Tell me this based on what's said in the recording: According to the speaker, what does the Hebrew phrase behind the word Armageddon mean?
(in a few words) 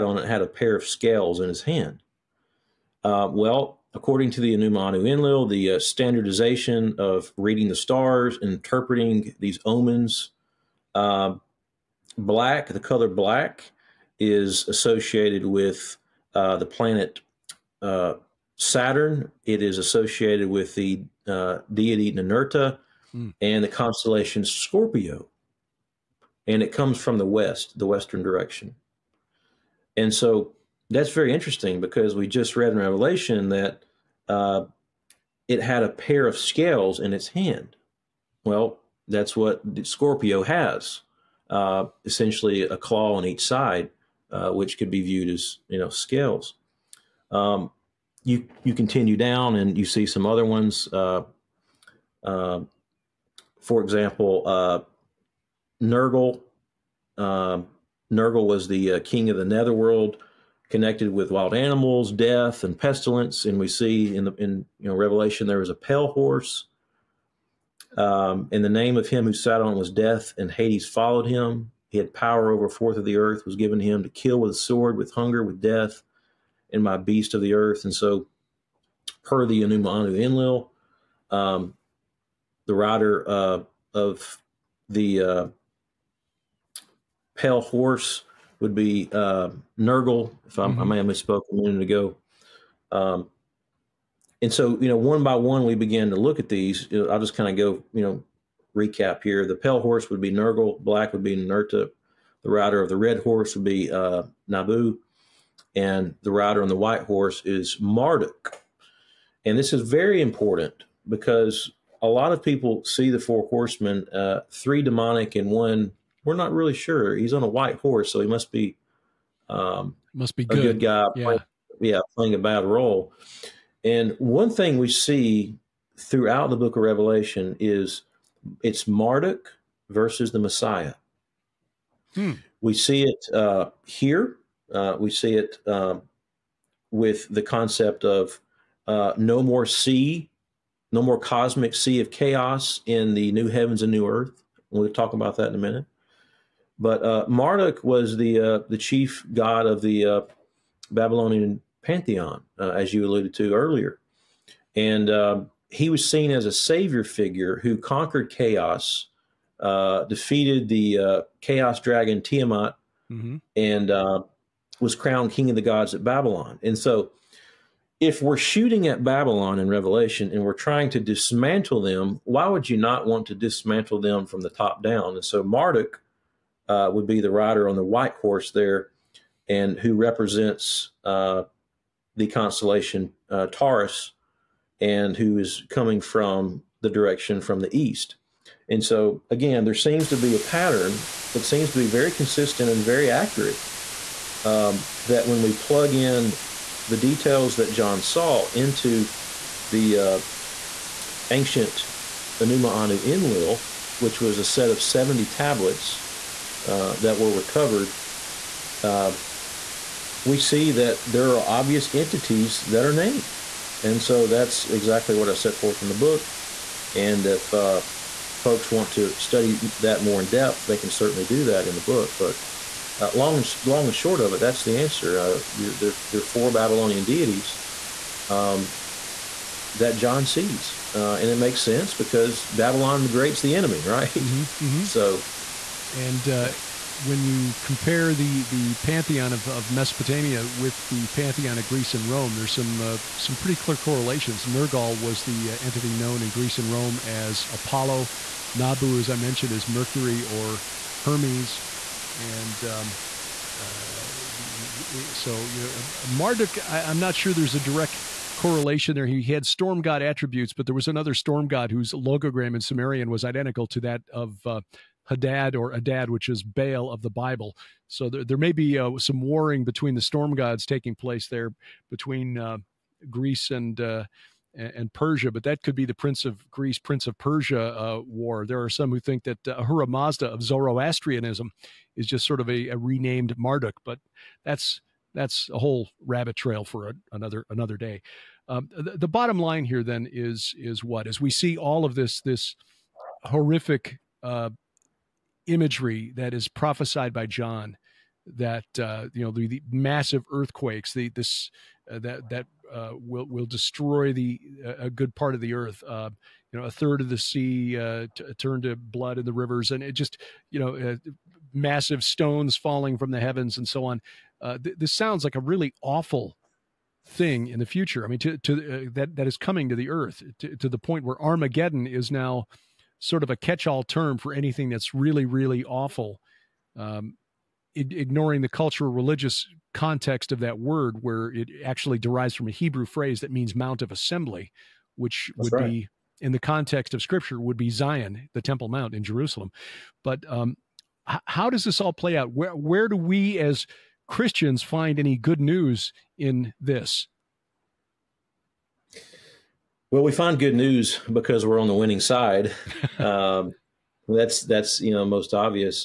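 Mount of Assembly.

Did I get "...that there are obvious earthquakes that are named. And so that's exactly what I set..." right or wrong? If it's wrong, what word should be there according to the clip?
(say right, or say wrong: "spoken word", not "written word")
wrong: "entities", not "earthquakes".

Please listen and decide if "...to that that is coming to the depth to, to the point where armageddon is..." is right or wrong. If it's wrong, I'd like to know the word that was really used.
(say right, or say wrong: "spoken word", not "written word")
wrong: "earth", not "depth".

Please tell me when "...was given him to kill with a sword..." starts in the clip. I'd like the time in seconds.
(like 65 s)
73 s.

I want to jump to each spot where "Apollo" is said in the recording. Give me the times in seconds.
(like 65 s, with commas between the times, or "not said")
247 s.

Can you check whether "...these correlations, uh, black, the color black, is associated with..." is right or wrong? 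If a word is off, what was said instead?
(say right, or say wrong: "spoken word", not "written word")
wrong: "omens", not "correlations".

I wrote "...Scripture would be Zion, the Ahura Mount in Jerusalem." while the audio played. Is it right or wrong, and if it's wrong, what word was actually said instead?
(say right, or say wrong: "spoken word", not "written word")
wrong: "Temple", not "Ahura".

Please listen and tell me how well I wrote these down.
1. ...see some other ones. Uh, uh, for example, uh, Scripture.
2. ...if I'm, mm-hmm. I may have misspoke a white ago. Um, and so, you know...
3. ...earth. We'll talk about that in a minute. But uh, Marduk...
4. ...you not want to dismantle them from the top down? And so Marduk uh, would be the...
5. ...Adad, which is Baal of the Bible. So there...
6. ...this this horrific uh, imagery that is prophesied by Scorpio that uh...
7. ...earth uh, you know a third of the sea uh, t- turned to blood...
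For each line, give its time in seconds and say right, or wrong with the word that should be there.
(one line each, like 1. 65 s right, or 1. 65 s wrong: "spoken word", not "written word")
1. 49 s wrong: "Nergal", not "Scripture"
2. 90 s wrong: "minute", not "white"
3. 144 s right
4. 172 s right
5. 265 s right
6. 291 s wrong: "John", not "Scorpio"
7. 305 s right.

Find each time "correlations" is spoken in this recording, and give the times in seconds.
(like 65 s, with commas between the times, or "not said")
243 s, 258 s.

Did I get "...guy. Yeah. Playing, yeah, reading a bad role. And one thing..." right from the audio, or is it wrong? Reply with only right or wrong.
wrong.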